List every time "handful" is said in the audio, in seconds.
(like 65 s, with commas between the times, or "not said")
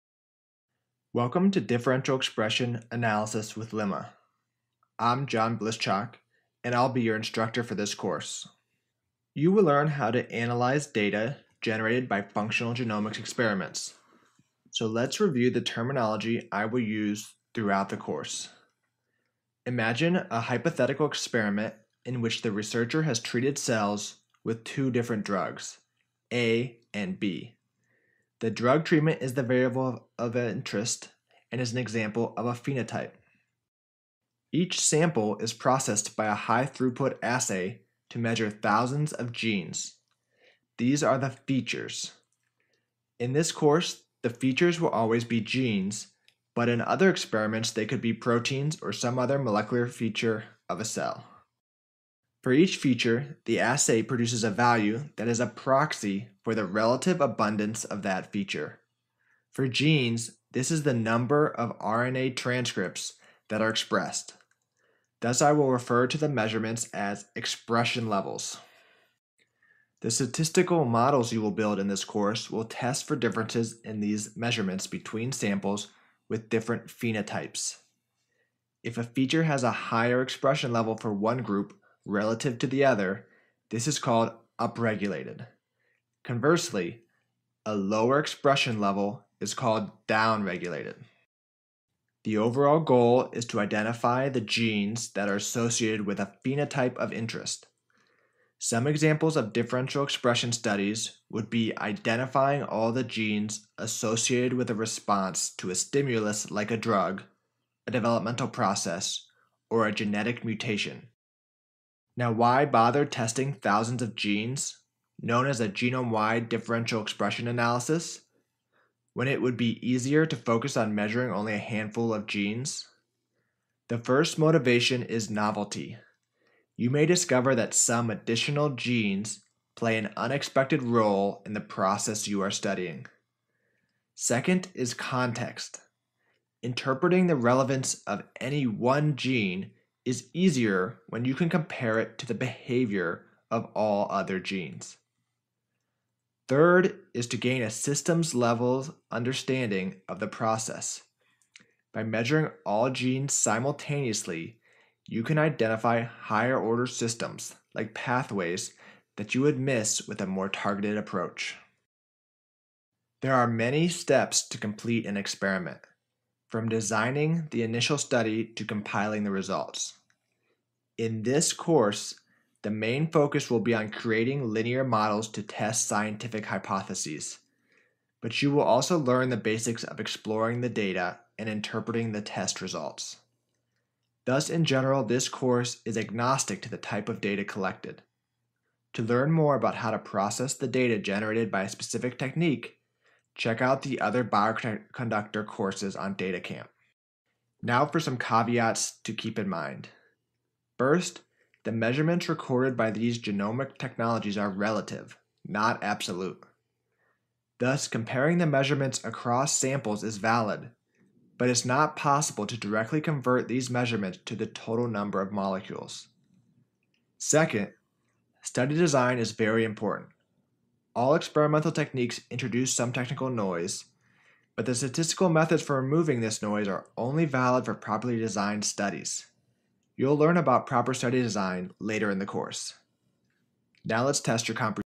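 121 s.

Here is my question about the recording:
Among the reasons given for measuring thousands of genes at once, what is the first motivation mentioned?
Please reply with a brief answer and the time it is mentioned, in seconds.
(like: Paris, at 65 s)
Novelty, at 125 s.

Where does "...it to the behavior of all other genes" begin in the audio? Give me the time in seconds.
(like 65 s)
141 s.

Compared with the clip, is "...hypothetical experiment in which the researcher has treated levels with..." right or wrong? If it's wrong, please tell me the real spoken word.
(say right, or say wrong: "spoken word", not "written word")
wrong: "cells", not "levels".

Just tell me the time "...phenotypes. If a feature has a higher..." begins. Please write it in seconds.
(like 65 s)
76 s.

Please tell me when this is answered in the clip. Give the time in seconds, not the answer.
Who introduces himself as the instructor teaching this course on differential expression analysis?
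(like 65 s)
5 s.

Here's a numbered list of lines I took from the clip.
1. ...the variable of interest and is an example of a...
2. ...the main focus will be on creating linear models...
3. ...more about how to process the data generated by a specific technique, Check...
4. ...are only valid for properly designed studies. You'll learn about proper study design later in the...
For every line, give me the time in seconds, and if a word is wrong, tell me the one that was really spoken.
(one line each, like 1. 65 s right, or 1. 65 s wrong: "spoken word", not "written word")
1. 29 s right
2. 172 s right
3. 189 s right
4. 226 s right.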